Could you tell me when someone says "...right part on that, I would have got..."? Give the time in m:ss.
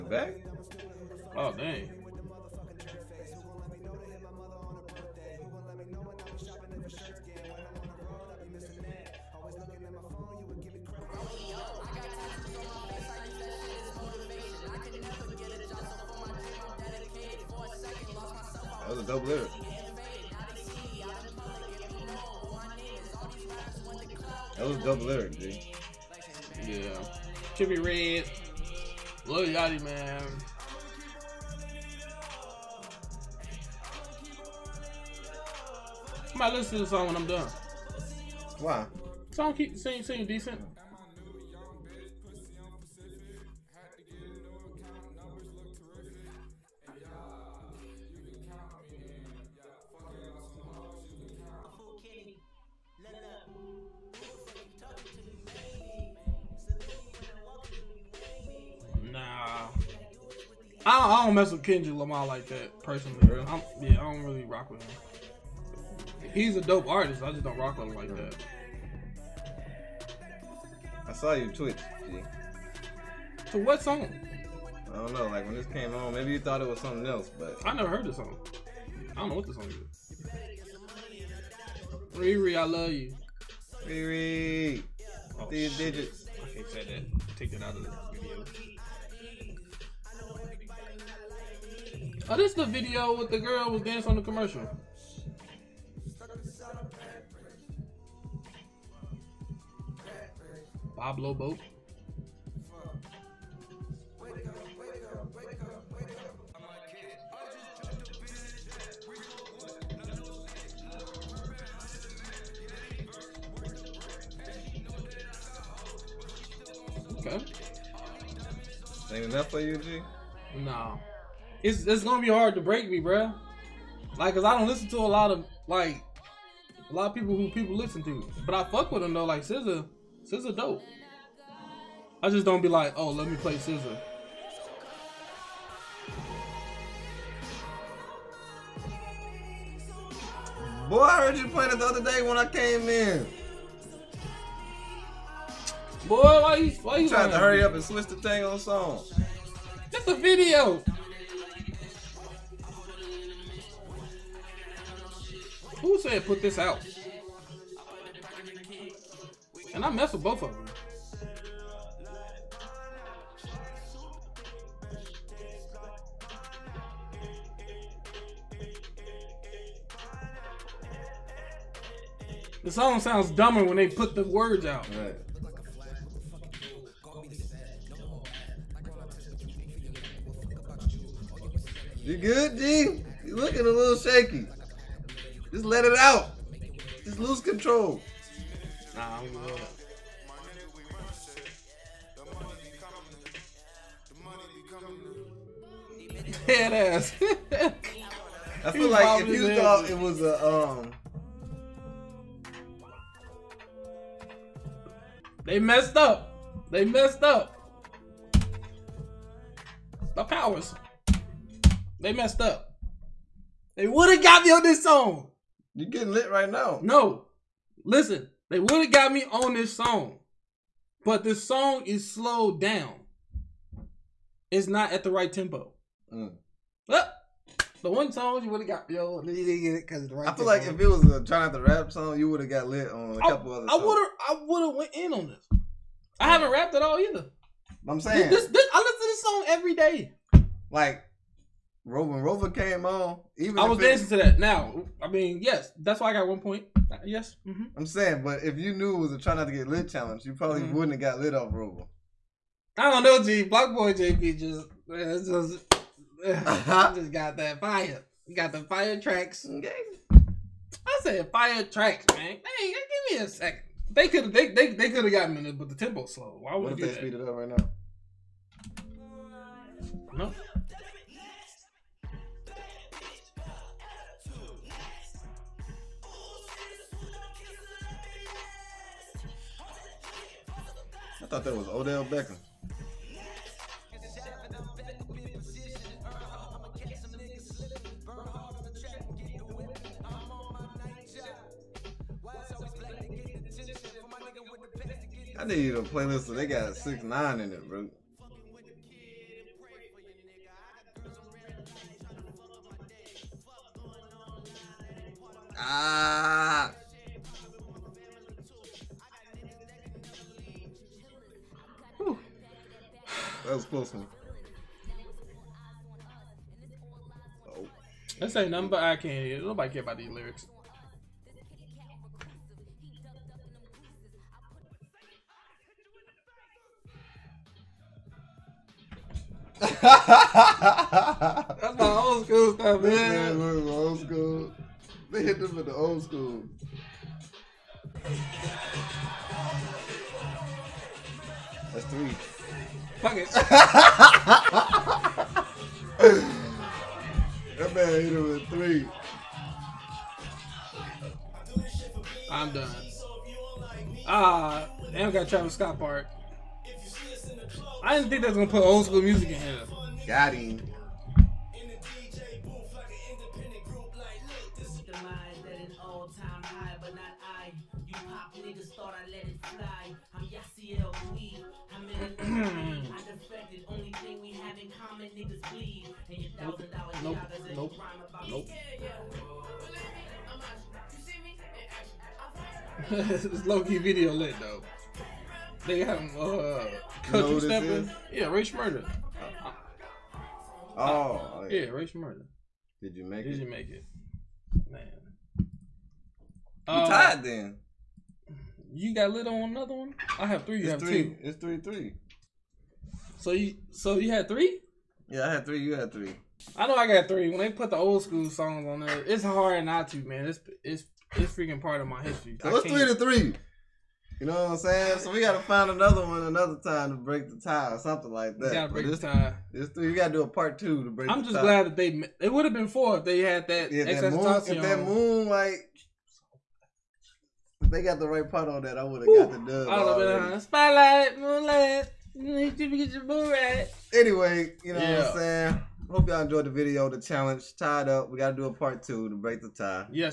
7:08.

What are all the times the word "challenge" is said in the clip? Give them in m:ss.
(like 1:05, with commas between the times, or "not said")
4:09, 7:17.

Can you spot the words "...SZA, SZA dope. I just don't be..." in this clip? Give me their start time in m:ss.
2:09.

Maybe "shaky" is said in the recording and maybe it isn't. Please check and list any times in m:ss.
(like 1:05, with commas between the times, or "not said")
3:03.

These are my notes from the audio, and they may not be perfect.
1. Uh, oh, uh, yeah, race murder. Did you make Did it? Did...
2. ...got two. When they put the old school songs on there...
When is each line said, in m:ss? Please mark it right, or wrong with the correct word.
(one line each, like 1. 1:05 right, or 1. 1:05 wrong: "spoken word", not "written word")
1. 6:30 right
2. 6:46 wrong: "three", not "two".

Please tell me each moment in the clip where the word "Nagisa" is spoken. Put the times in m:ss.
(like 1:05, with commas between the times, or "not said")
not said.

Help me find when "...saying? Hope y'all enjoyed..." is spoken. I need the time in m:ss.
7:15.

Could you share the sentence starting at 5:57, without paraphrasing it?
I didn't think they was gonna put old school music in here.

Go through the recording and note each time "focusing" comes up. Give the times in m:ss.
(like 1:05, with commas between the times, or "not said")
not said.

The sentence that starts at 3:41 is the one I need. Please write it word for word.
But this song is slowed down.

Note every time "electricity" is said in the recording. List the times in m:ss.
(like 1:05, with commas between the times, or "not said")
not said.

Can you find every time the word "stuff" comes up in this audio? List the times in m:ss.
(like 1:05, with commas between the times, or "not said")
5:32.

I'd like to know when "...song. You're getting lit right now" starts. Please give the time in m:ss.
3:34.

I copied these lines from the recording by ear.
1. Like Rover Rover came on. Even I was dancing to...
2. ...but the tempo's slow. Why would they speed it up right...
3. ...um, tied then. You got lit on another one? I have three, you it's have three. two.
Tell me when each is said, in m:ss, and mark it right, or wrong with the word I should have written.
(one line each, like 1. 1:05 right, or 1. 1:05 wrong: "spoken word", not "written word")
1. 4:00 right
2. 4:25 right
3. 6:36 right.